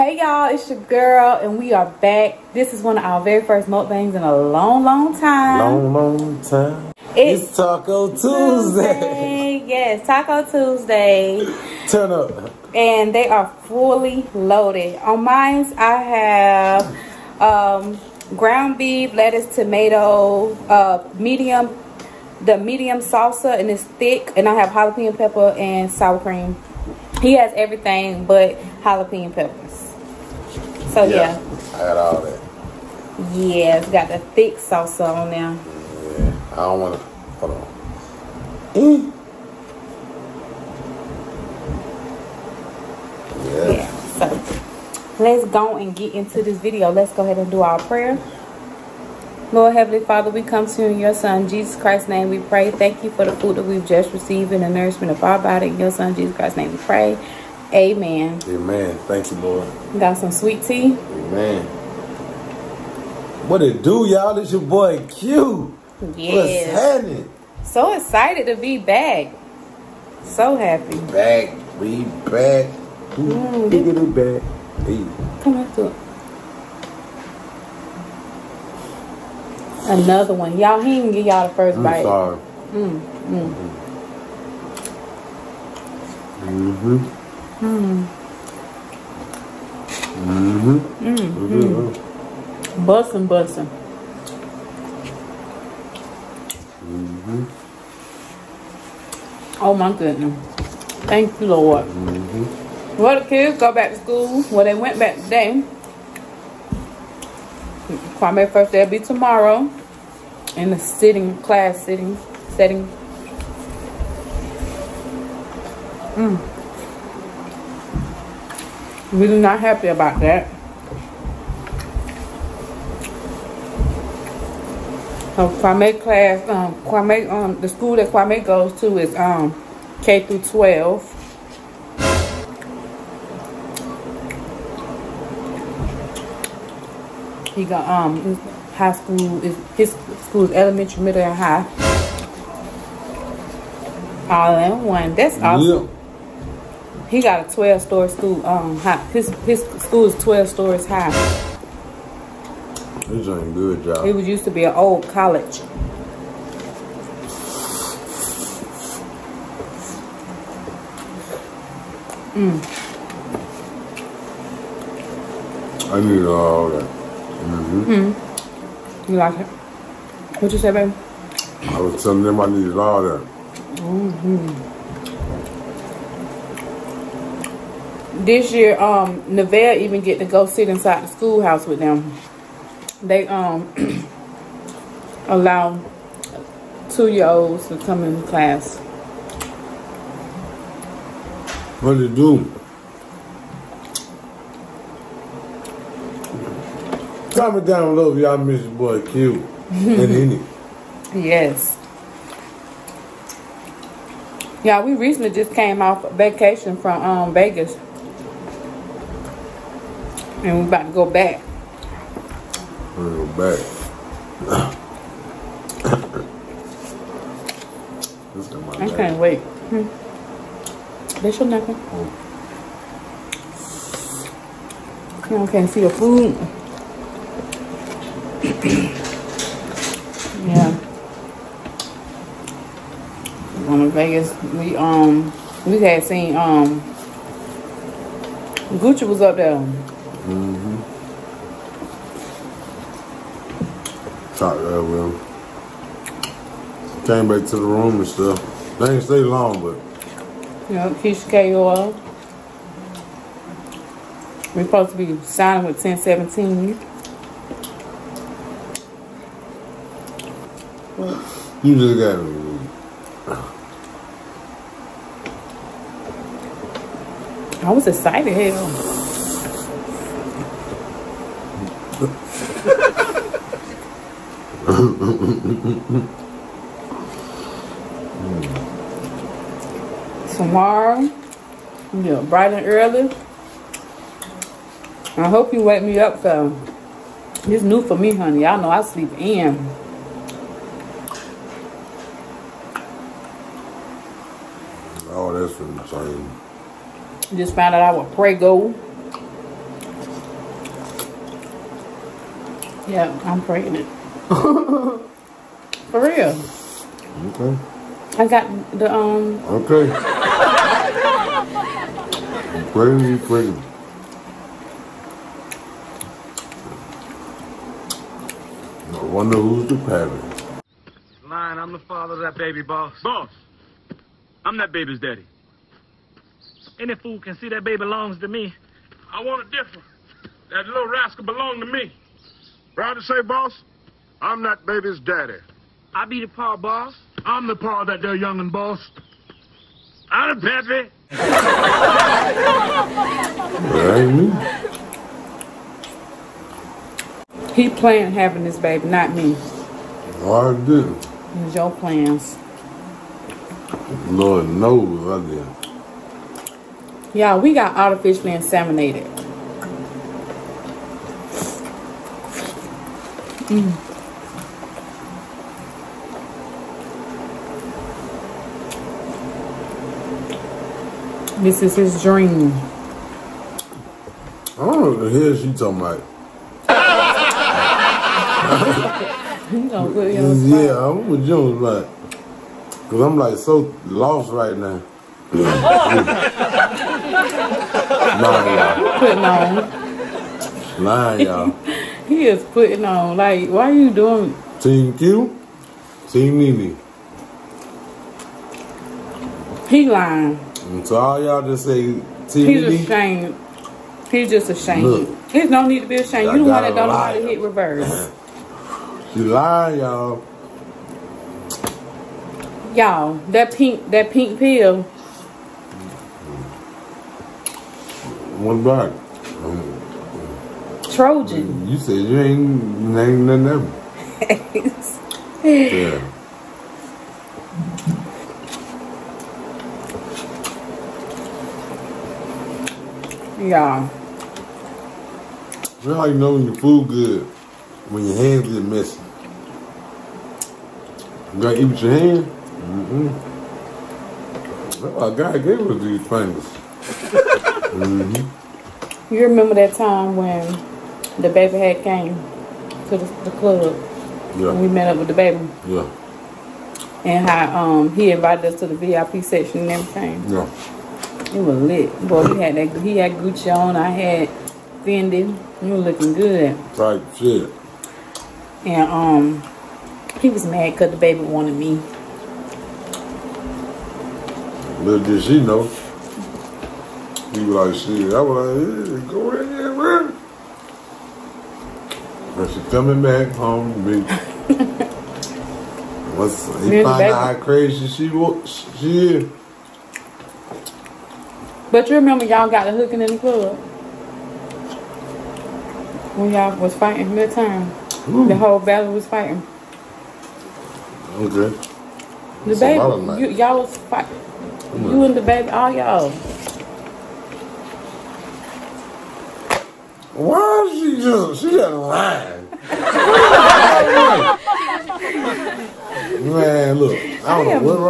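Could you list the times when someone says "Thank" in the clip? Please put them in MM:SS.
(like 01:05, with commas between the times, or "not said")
00:52, 00:59, 01:41.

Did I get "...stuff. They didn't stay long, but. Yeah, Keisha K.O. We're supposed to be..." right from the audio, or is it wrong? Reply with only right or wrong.
right.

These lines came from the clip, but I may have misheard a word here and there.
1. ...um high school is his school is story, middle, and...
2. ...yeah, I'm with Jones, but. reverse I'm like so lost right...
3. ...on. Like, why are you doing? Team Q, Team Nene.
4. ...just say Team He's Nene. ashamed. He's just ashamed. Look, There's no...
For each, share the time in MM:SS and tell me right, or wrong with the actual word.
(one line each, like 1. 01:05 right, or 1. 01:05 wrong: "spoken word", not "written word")
1. 02:17 wrong: "elementary", not "story"
2. 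06:20 wrong: "cause", not "reverse"
3. 06:32 right
4. 06:41 right.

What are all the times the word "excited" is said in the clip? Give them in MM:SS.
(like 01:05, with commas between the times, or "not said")
01:07, 04:27.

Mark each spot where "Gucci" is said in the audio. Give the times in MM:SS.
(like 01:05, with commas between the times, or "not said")
03:58, 07:43.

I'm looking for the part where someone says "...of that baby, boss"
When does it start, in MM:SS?
05:22.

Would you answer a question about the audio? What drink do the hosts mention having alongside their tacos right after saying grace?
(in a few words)
Sweet tea.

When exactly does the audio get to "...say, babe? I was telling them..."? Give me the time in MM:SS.
02:50.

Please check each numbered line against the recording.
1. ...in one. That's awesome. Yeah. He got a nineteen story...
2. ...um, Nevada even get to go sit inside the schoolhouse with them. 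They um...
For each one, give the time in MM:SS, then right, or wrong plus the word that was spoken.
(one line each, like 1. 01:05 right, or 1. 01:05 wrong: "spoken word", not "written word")
1. 02:24 wrong: "twelve", not "nineteen"
2. 02:58 right.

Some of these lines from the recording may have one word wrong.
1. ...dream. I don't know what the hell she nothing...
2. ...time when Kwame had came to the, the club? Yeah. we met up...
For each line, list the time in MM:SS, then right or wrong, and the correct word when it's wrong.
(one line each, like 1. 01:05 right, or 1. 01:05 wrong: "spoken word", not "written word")
1. 06:12 wrong: "talking", not "nothing"
2. 07:29 wrong: "DaBaby", not "Kwame".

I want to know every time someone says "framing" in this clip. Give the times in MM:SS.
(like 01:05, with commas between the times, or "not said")
not said.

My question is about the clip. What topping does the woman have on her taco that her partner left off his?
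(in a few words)
Jalapeno peppers.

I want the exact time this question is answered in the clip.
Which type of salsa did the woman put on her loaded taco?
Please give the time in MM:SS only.
00:22.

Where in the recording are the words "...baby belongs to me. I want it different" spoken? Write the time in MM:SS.
05:27.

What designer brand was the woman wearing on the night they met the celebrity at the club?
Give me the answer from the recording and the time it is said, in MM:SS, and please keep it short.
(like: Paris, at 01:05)
Fendi, at 07:44.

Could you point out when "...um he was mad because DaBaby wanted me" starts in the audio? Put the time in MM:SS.
07:48.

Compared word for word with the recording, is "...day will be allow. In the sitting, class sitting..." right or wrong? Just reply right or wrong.
wrong.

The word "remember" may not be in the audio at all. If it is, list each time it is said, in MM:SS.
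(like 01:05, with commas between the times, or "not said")
07:29, 08:11.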